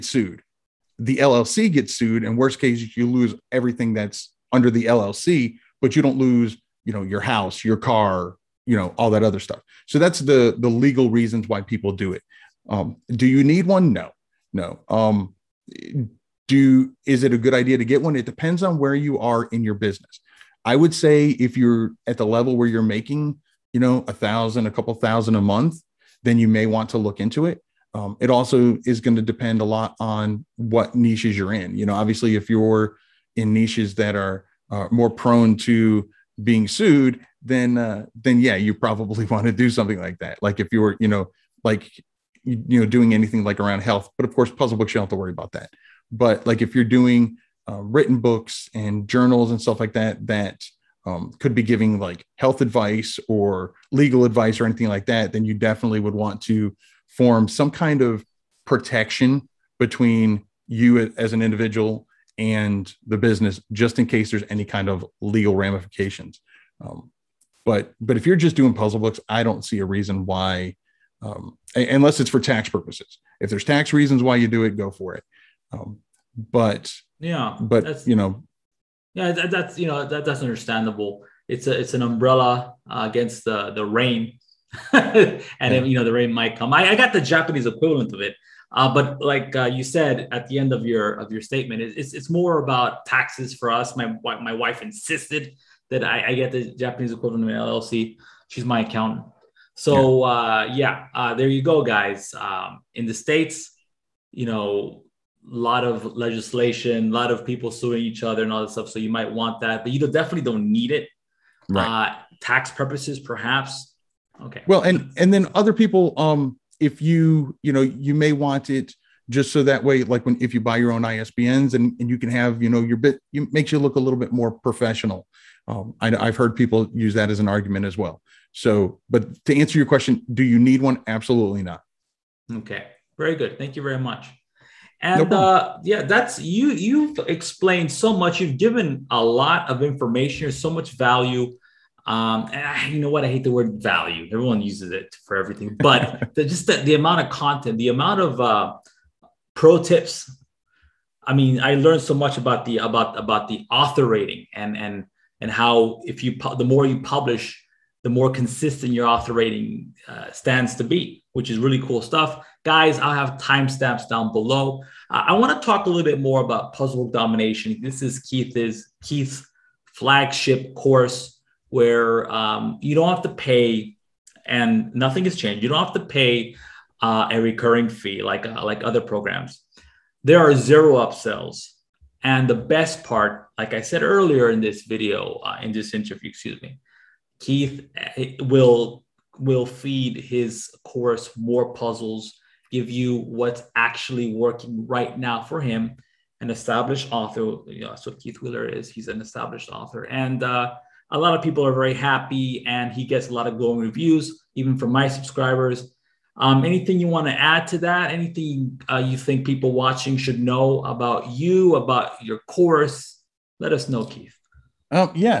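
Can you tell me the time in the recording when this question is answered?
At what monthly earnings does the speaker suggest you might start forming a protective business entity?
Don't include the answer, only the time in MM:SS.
00:24.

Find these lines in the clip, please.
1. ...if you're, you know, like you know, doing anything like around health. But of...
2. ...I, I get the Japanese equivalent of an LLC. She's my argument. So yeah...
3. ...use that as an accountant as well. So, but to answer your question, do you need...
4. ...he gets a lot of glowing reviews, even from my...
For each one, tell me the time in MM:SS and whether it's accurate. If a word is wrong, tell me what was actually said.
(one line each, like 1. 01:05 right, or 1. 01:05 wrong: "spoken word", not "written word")
1. 00:40 right
2. 01:36 wrong: "accountant", not "argument"
3. 02:06 wrong: "argument", not "accountant"
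4. 03:22 right.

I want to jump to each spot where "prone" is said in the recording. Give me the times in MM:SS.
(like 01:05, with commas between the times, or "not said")
00:35.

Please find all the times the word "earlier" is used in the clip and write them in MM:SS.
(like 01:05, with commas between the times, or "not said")
03:04.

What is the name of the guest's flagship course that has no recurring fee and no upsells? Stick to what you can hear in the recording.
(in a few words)
Puzzle Domination.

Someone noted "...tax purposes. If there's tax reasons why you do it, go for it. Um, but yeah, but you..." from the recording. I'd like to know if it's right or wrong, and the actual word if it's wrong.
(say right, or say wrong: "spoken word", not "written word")
right.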